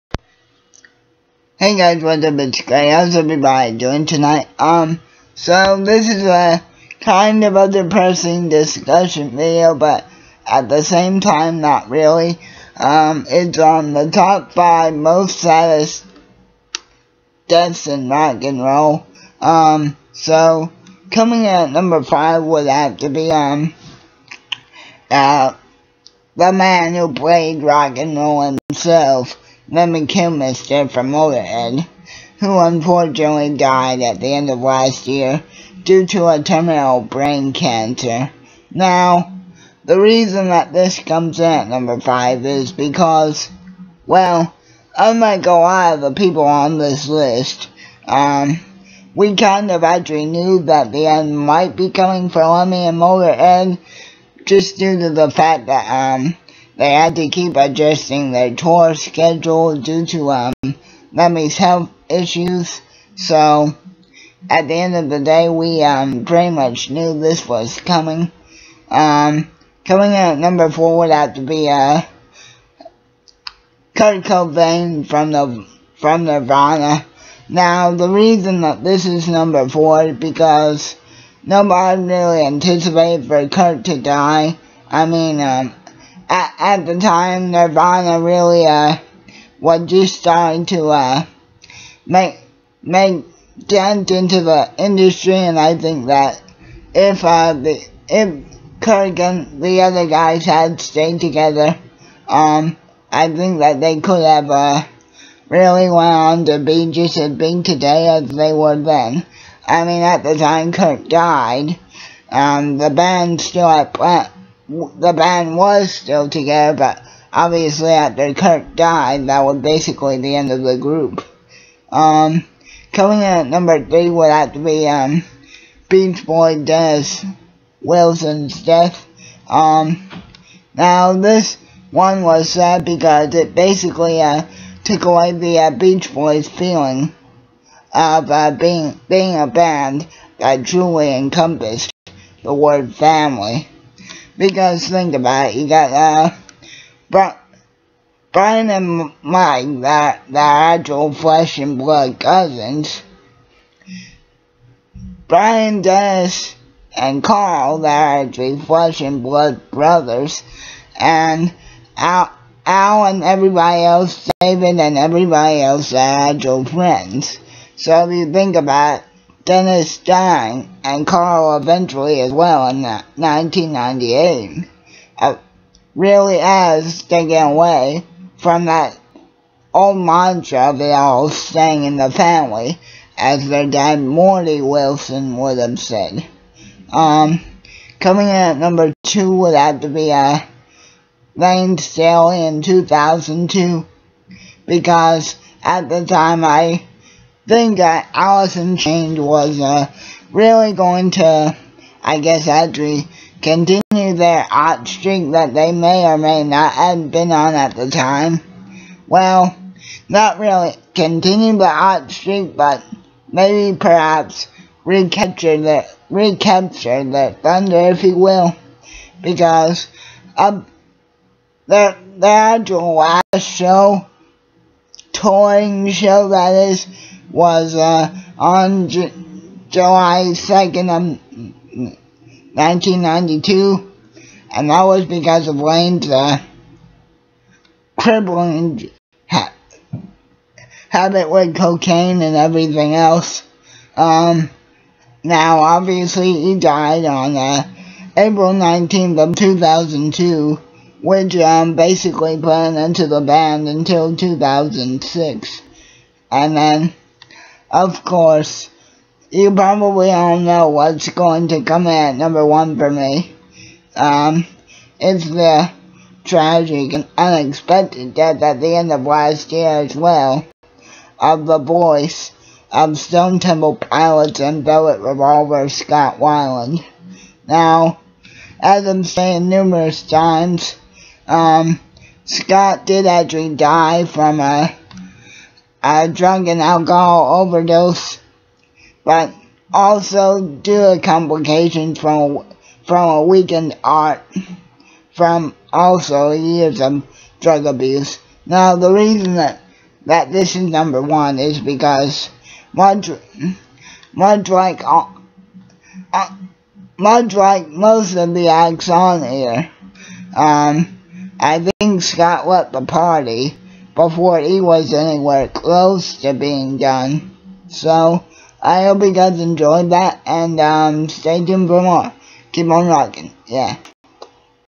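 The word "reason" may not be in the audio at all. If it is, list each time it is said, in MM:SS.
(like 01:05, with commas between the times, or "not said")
00:39, 01:18, 04:58.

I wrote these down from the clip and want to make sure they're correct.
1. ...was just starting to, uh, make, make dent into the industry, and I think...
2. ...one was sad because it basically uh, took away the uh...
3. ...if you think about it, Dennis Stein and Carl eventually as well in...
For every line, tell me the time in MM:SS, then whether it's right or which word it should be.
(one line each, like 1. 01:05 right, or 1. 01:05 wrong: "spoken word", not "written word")
1. 01:29 right
2. 02:11 right
3. 02:48 right.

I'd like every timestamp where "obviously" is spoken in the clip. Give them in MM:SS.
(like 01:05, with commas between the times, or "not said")
01:57, 04:05.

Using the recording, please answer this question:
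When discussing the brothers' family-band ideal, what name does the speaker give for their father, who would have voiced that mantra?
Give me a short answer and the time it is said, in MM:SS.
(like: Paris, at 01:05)
Morty Wilson, at 03:04.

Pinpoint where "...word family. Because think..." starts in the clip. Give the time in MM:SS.
02:22.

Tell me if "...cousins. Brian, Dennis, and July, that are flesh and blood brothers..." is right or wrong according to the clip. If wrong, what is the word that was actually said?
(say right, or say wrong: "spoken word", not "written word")
wrong: "Carl", not "July".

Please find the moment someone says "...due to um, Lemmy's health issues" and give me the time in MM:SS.
00:59.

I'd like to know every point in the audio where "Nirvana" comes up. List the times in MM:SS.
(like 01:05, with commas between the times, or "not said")
01:16, 01:27.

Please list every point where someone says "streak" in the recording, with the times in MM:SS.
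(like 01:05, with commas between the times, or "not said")
03:24, 03:32.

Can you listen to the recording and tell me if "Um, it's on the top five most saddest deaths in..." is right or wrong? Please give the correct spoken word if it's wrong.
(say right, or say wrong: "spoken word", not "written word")
right.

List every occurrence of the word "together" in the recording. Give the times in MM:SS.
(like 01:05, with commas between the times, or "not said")
01:41, 01:56.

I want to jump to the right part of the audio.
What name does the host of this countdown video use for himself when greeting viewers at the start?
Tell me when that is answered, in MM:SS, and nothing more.
00:02.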